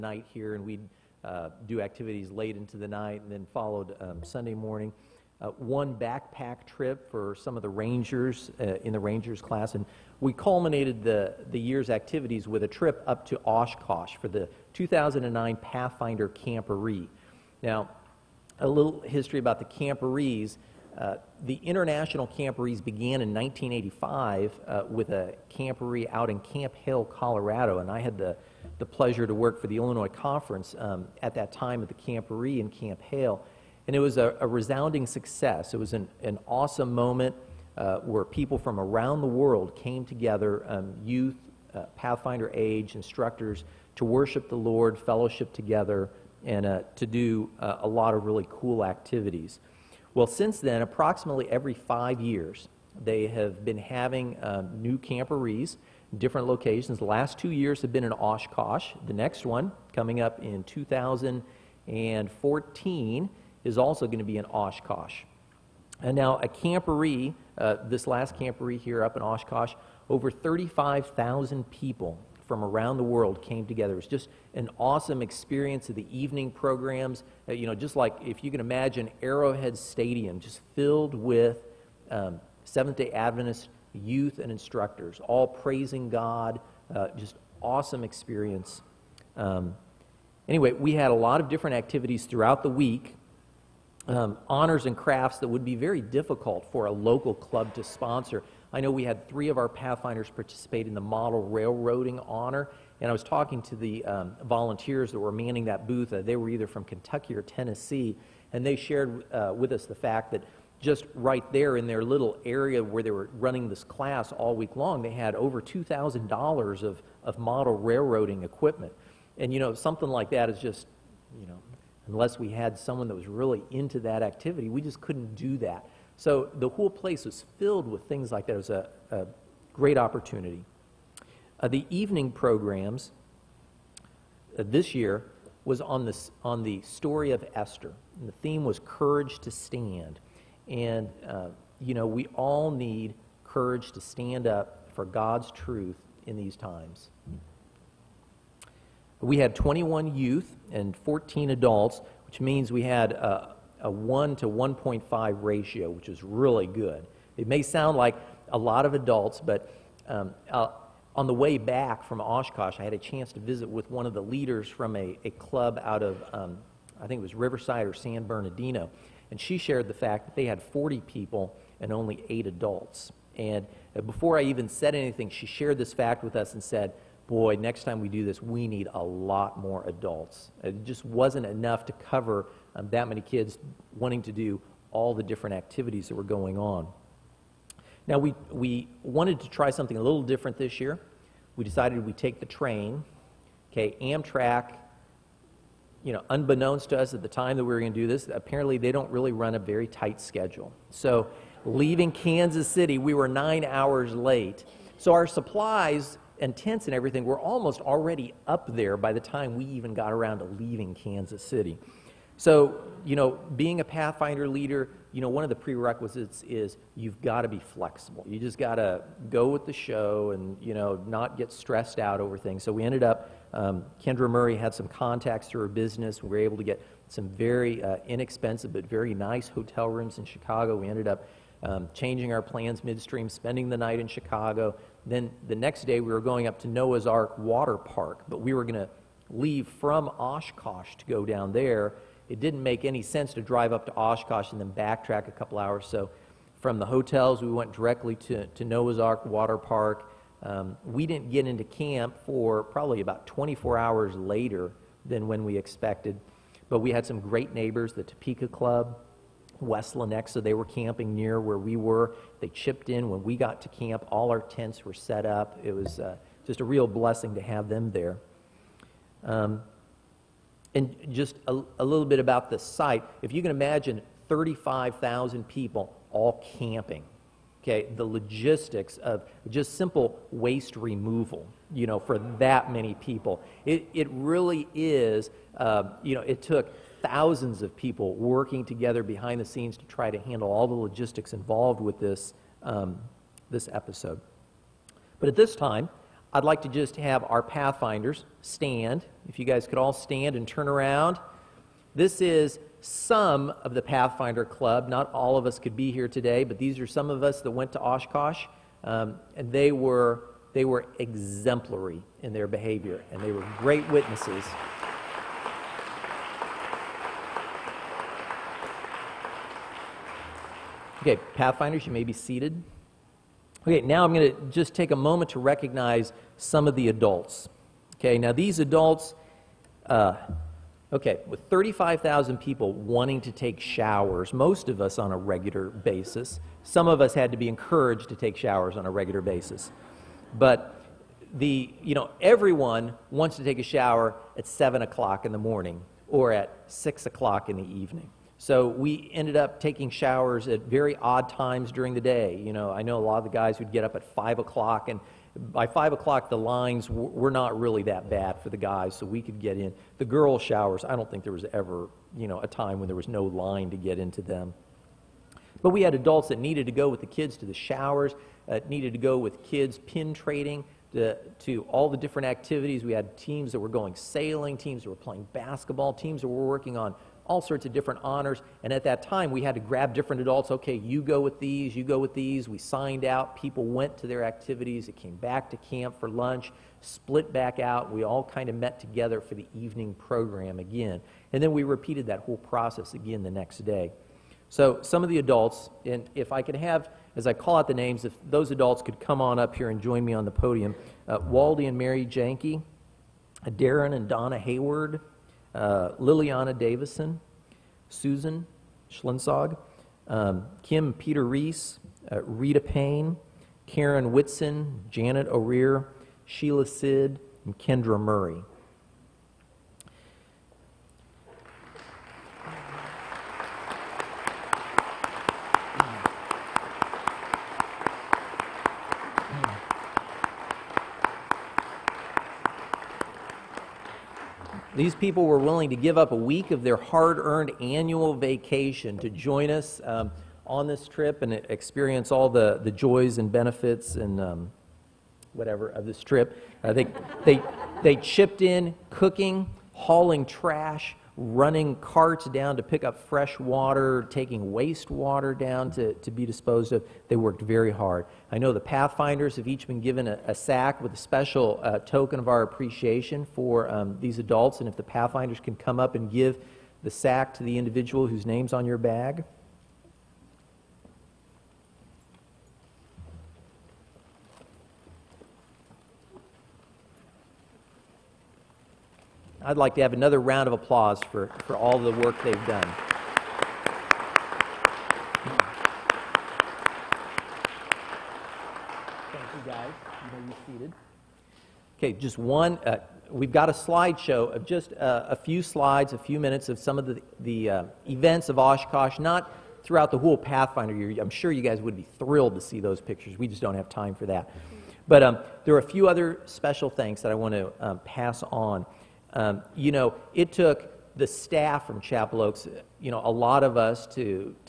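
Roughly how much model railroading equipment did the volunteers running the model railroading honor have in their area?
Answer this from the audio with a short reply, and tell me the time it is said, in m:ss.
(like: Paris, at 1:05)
Over $2,000, at 1:55.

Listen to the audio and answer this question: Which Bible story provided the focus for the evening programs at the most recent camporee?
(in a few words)
Esther.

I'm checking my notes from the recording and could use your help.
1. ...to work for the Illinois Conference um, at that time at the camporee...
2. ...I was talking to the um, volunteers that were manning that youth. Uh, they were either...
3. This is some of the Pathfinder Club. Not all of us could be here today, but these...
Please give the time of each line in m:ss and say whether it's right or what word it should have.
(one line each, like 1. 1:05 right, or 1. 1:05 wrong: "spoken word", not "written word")
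1. 0:29 right
2. 1:43 wrong: "booth", not "youth"
3. 5:01 right.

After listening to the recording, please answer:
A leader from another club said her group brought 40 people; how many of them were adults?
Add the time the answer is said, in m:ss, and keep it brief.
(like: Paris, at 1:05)
8, at 2:52.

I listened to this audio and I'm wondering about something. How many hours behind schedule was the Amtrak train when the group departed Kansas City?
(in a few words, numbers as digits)
9.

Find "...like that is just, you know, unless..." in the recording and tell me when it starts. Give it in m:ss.
2:00.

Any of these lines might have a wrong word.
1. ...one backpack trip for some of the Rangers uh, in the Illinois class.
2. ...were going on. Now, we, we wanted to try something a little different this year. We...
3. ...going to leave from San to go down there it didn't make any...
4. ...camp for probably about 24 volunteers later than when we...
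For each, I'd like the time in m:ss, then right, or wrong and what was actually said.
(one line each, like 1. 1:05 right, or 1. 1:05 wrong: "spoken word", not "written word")
1. 0:05 wrong: "Rangers", not "Illinois"
2. 3:06 right
3. 3:58 wrong: "Oshkosh", not "San"
4. 4:11 wrong: "hours", not "volunteers".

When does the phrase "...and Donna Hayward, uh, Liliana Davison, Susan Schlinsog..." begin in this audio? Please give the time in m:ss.
6:43.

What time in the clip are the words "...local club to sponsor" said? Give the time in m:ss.
1:36.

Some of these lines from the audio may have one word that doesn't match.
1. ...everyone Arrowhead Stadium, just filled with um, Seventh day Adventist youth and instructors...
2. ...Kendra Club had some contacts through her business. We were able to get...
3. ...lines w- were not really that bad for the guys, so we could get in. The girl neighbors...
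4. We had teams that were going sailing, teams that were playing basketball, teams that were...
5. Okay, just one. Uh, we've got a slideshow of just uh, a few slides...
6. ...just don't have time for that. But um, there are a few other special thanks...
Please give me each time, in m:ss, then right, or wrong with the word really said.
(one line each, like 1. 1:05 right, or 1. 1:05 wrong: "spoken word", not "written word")
1. 1:18 wrong: "imagine", not "everyone"
2. 3:44 wrong: "Murray", not "Club"
3. 5:56 wrong: "showers", not "neighbors"
4. 6:12 right
5. 8:11 right
6. 8:23 right.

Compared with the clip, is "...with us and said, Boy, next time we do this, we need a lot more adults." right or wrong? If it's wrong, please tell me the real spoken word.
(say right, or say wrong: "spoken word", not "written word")
right.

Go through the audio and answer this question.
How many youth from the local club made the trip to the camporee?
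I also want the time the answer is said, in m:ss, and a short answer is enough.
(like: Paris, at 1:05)
21, at 2:29.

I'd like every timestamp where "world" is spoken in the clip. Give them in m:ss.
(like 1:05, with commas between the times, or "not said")
0:39, 1:13.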